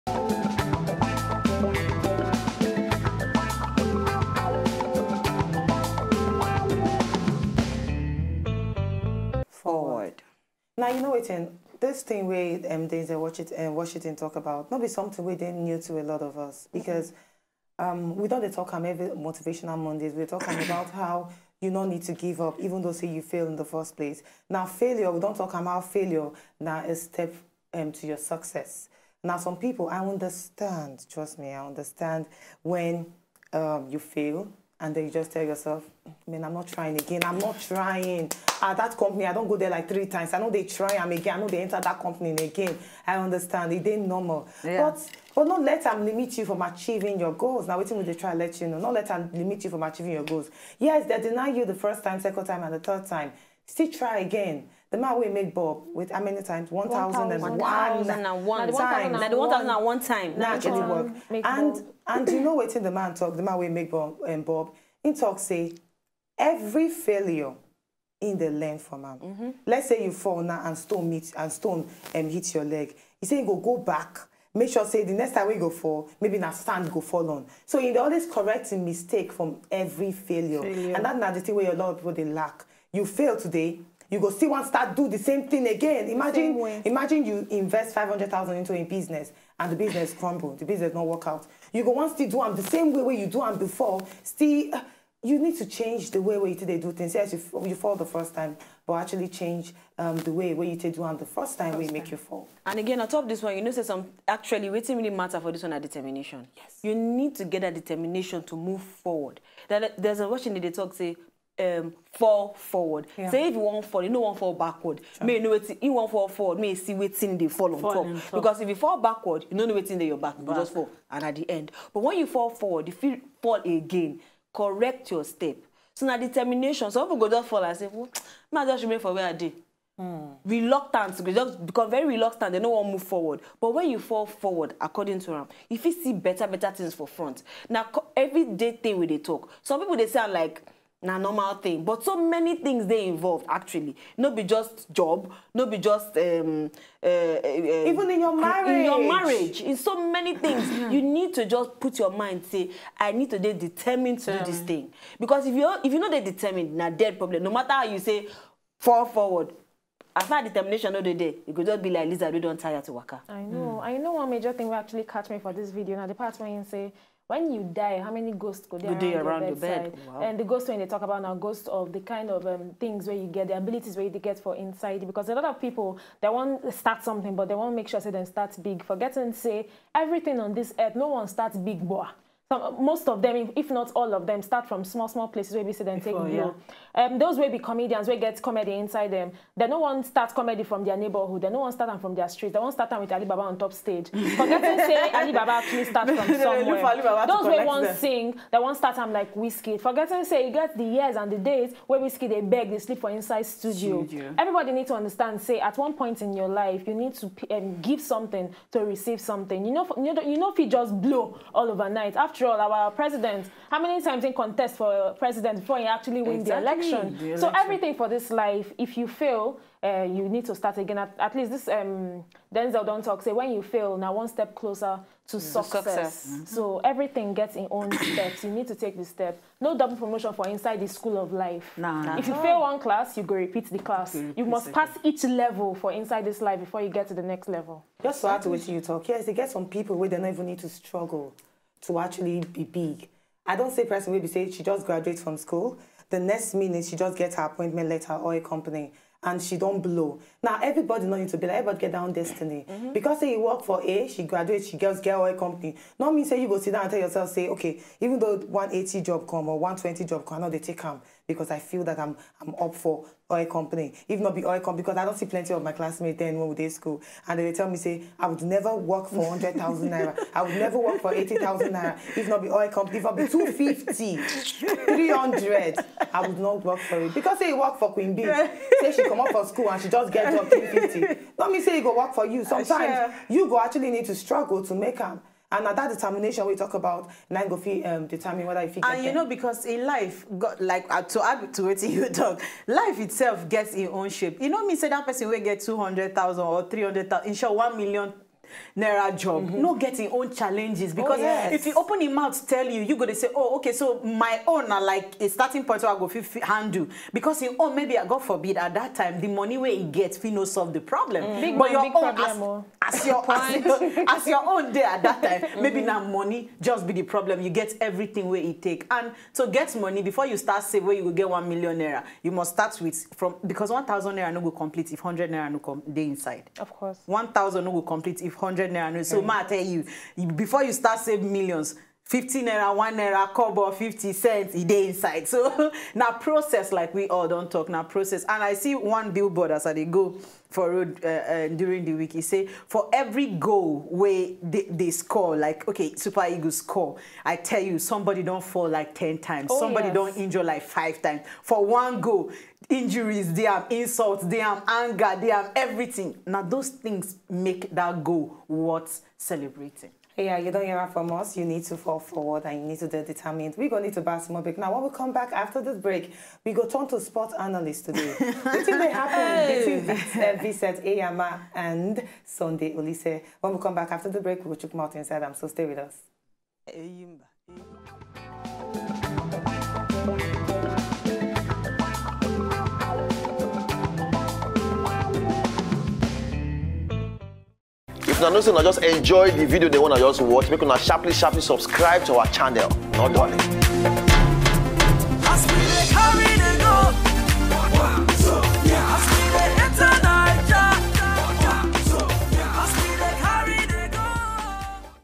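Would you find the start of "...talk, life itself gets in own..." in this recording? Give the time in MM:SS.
04:52.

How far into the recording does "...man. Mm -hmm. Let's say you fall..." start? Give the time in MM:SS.
01:08.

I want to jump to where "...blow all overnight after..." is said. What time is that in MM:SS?
03:31.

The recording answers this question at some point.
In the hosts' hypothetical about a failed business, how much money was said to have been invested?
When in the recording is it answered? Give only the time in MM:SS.
01:27.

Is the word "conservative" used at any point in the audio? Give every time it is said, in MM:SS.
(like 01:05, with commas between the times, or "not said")
not said.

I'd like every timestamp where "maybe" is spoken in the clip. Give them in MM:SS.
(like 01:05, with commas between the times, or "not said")
01:16, 05:07, 05:15.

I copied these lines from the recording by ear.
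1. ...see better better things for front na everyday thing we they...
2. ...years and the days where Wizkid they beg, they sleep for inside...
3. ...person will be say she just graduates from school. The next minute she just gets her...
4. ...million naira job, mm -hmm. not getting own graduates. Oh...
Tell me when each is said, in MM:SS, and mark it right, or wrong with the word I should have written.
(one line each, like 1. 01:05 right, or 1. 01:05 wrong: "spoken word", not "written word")
1. 02:15 right
2. 03:20 right
3. 04:03 right
4. 04:57 wrong: "challenges", not "graduates".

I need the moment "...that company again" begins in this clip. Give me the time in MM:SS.
00:41.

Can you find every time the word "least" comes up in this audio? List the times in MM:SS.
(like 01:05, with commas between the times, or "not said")
03:41.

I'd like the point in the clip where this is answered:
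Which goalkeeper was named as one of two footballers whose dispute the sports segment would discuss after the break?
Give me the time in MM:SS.
06:10.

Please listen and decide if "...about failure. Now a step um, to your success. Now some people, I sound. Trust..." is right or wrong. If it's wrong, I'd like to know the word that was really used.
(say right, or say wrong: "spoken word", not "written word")
wrong: "understand", not "sound".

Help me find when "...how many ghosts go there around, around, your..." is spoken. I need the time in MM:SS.
02:48.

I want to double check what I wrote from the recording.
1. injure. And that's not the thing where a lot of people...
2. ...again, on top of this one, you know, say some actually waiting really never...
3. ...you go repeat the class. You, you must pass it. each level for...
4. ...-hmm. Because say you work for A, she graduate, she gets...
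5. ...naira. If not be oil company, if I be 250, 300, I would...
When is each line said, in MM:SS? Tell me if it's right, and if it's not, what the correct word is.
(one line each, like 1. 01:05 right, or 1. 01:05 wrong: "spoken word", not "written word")
1. 01:20 wrong: "failure", not "injure"
2. 01:42 wrong: "matter", not "never"
3. 03:53 right
4. 04:12 right
5. 04:31 right.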